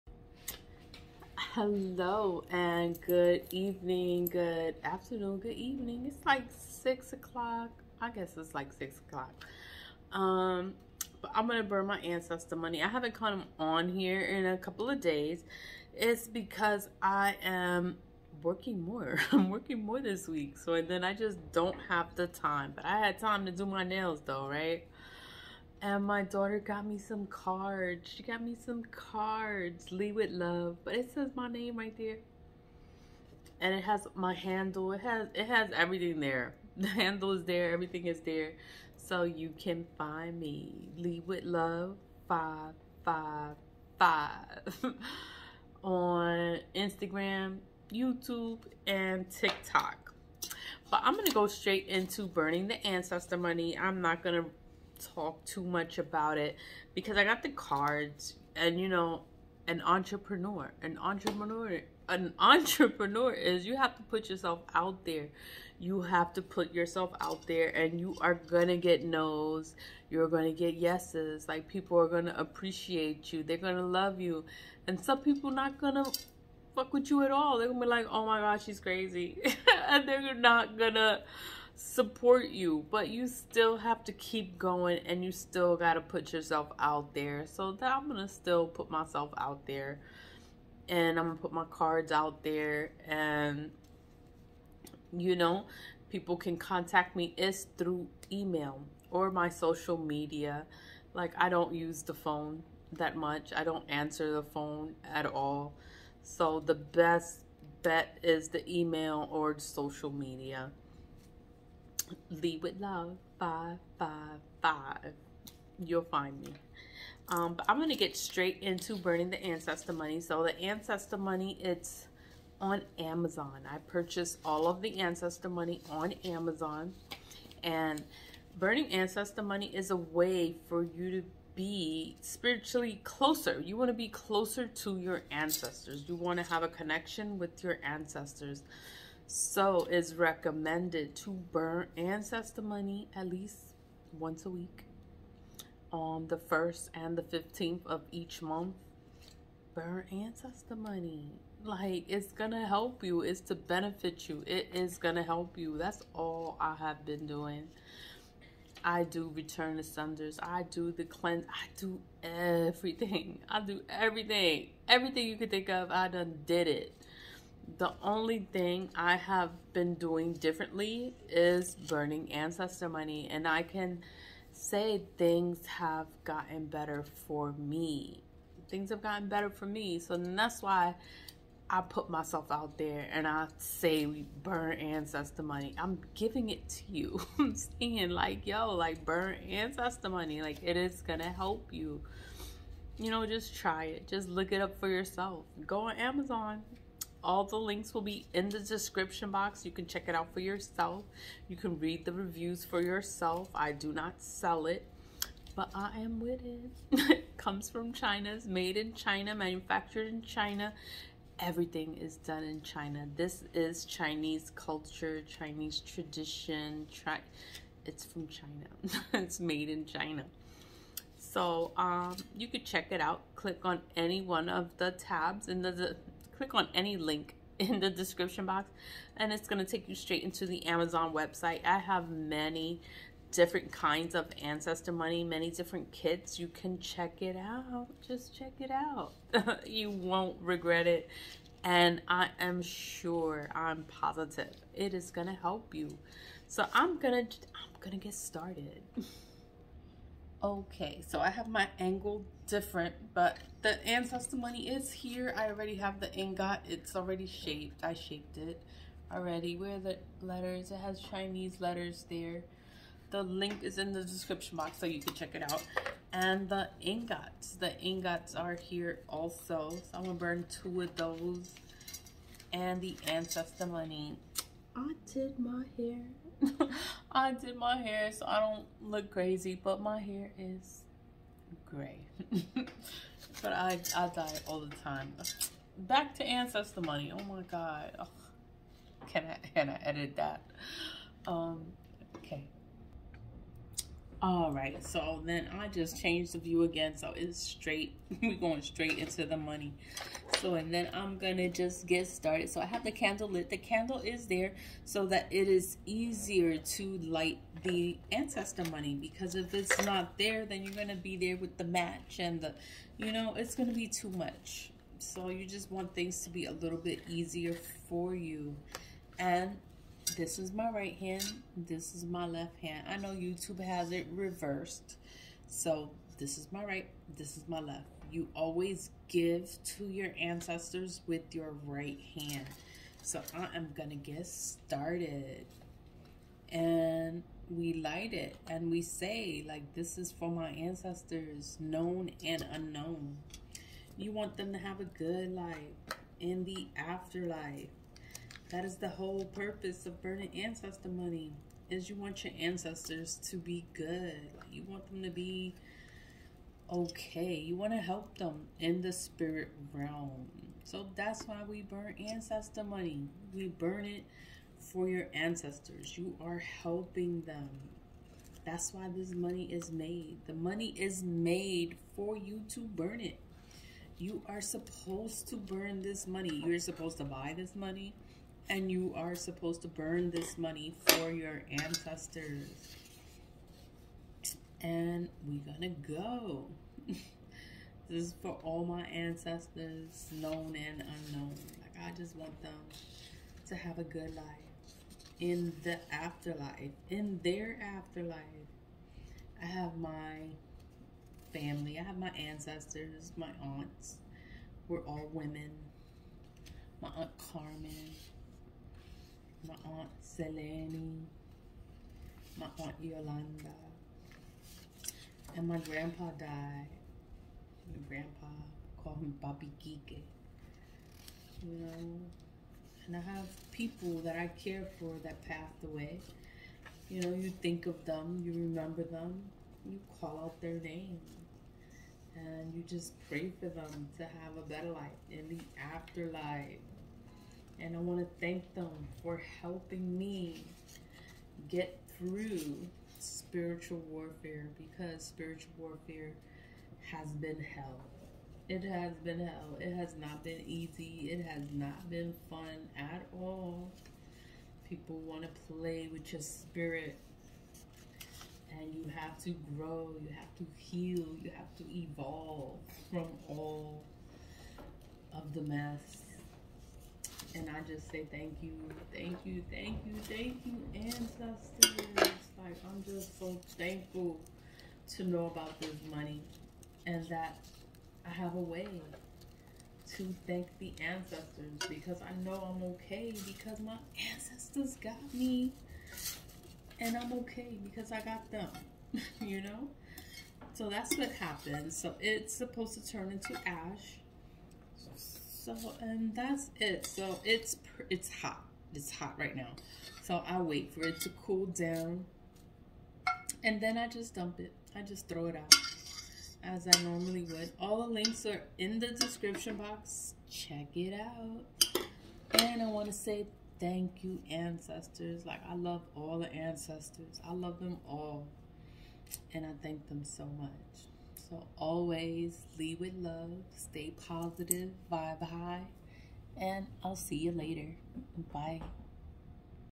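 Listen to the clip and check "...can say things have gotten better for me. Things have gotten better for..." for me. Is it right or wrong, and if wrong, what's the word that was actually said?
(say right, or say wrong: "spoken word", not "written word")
right.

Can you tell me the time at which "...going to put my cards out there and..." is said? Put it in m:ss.
1:31.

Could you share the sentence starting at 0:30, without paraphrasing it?
But it says my name right there.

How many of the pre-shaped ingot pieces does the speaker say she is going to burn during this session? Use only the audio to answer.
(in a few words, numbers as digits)
2.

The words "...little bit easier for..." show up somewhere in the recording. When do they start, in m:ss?
5:16.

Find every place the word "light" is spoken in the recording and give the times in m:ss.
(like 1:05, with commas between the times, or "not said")
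5:06, 5:37.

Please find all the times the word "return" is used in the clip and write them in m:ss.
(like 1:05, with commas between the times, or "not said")
2:39.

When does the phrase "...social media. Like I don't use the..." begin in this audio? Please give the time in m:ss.
1:39.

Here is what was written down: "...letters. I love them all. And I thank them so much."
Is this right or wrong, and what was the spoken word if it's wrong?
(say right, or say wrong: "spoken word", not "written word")
wrong: "ancestors", not "letters".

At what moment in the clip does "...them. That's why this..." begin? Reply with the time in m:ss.
6:07.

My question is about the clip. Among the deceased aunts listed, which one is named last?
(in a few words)
Aunt Yolanda.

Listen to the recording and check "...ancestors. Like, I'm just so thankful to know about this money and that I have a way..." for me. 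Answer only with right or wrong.
right.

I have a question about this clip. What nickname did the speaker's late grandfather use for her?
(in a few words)
Bobby Geek.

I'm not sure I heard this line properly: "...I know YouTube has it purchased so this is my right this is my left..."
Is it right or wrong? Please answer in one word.
wrong.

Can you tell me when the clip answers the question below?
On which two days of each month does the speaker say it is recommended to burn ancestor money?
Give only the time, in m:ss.
2:26.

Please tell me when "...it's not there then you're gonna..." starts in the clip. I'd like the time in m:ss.
5:09.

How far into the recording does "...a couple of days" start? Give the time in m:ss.
0:14.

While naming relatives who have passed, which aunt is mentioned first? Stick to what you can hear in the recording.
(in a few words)
Aunt Carmen.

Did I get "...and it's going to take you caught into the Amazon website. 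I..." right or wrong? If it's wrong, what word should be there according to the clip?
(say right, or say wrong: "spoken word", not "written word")
wrong: "straight", not "caught".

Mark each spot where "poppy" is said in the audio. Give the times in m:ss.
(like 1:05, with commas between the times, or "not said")
not said.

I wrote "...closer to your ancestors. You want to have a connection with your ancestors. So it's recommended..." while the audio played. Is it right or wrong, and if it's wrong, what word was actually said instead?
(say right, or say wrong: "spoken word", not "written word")
right.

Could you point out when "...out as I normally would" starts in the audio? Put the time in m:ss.
8:25.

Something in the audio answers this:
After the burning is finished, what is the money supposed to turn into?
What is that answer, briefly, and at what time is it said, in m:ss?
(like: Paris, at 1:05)
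Ash, at 8:13.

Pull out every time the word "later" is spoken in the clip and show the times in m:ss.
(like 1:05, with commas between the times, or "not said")
8:47.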